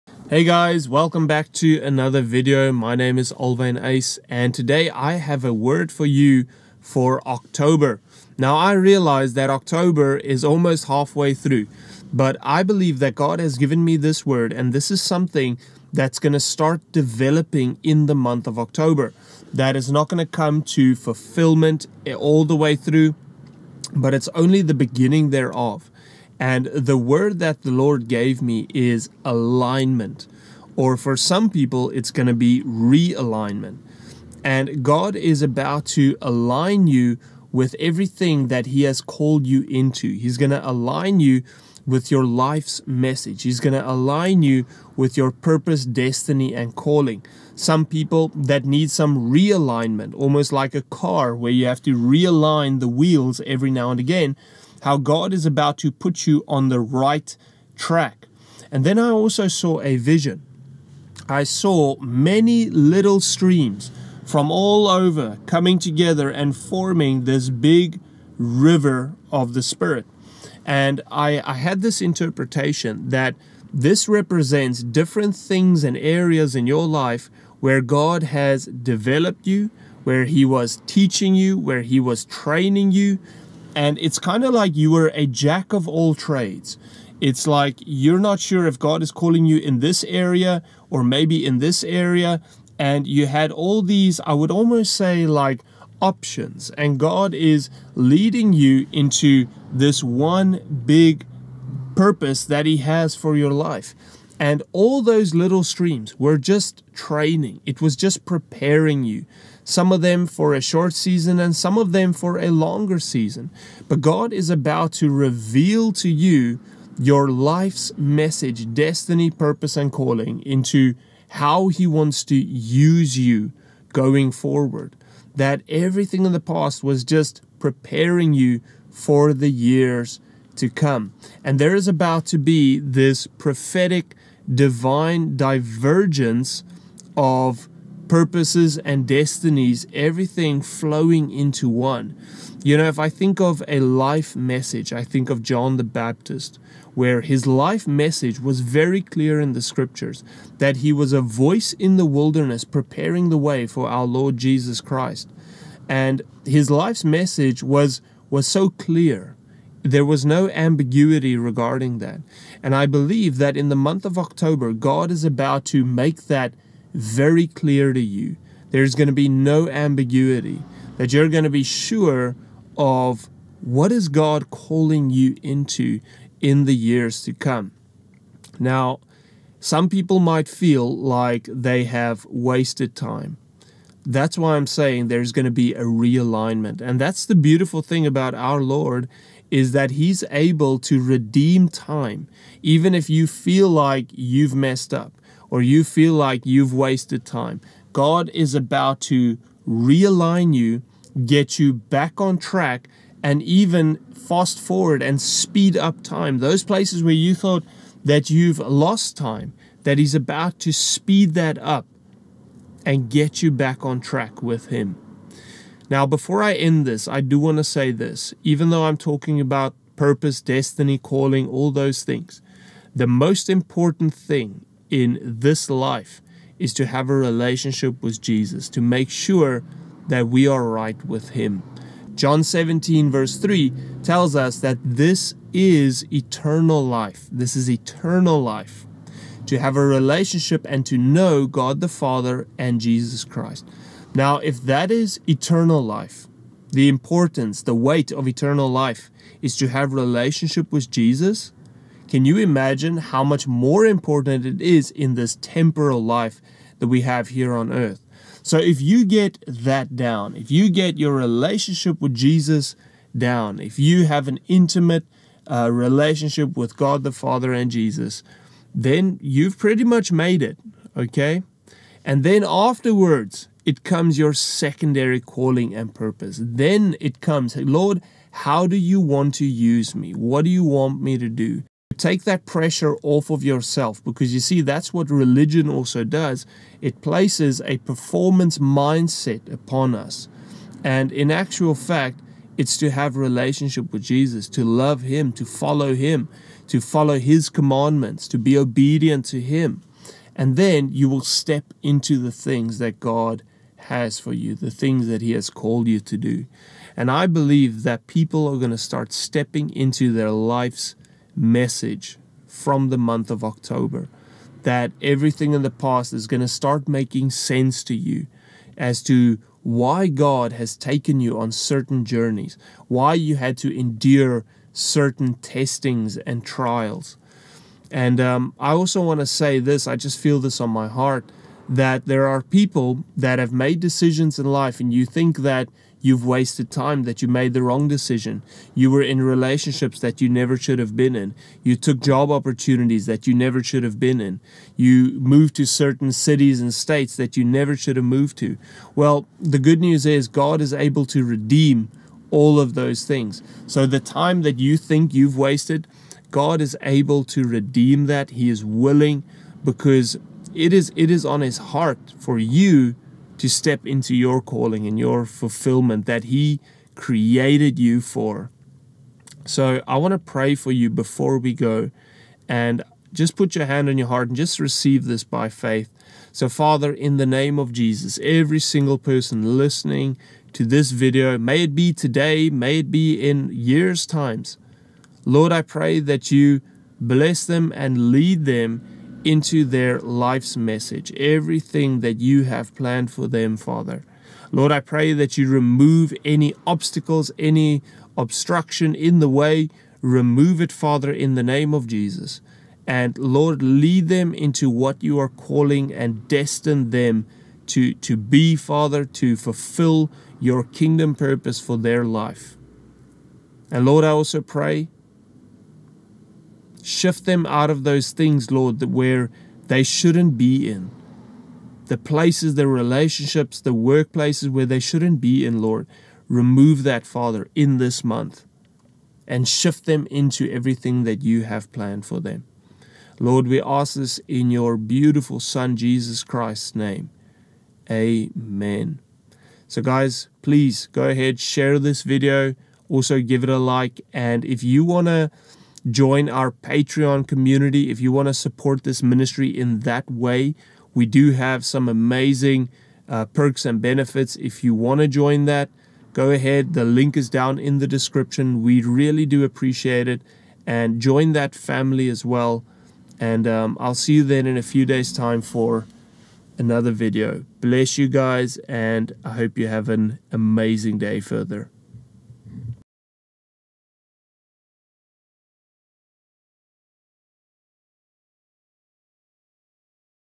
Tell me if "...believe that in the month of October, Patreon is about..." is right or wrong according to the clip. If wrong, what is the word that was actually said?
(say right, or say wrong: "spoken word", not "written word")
wrong: "God", not "Patreon".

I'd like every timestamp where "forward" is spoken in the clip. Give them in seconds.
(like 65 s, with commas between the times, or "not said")
124 s, 204 s.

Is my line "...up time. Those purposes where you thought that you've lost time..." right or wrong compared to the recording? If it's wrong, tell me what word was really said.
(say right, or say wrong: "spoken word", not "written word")
wrong: "places", not "purposes".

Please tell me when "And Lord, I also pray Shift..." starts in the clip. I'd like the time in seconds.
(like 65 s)
413 s.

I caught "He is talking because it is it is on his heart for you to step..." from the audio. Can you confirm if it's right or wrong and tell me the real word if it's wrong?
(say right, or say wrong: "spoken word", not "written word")
wrong: "willing", not "talking".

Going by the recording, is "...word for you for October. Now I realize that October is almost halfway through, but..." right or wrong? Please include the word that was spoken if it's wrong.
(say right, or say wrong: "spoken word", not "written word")
right.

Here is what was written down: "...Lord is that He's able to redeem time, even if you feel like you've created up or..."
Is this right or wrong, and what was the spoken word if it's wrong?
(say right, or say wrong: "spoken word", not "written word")
wrong: "messed", not "created".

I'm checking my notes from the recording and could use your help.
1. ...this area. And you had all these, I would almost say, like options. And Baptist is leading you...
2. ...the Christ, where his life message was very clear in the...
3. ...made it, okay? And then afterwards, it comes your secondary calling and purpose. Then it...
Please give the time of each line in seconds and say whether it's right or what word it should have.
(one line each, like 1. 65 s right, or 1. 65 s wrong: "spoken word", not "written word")
1. 91 s wrong: "God", not "Baptist"
2. 145 s wrong: "Baptist", not "Christ"
3. 270 s right.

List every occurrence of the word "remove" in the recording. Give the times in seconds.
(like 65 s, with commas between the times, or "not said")
395 s, 400 s, 426 s.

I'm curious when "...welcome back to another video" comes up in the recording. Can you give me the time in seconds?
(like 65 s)
0 s.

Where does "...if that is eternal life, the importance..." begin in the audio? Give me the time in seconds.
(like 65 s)
244 s.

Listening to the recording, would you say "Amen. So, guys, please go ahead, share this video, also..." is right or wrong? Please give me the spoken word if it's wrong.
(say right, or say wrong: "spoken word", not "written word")
right.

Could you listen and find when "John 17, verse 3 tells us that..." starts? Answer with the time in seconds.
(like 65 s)
232 s.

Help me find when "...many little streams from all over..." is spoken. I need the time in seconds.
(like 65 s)
61 s.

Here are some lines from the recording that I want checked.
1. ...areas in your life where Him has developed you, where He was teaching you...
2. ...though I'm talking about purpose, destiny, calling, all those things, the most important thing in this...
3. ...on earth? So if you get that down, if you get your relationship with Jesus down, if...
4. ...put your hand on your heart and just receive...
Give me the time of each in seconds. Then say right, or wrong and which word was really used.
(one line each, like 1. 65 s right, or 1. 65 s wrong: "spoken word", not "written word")
1. 75 s wrong: "God", not "Him"
2. 218 s right
3. 257 s right
4. 373 s right.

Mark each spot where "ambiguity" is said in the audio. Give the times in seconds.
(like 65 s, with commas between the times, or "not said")
160 s, 169 s.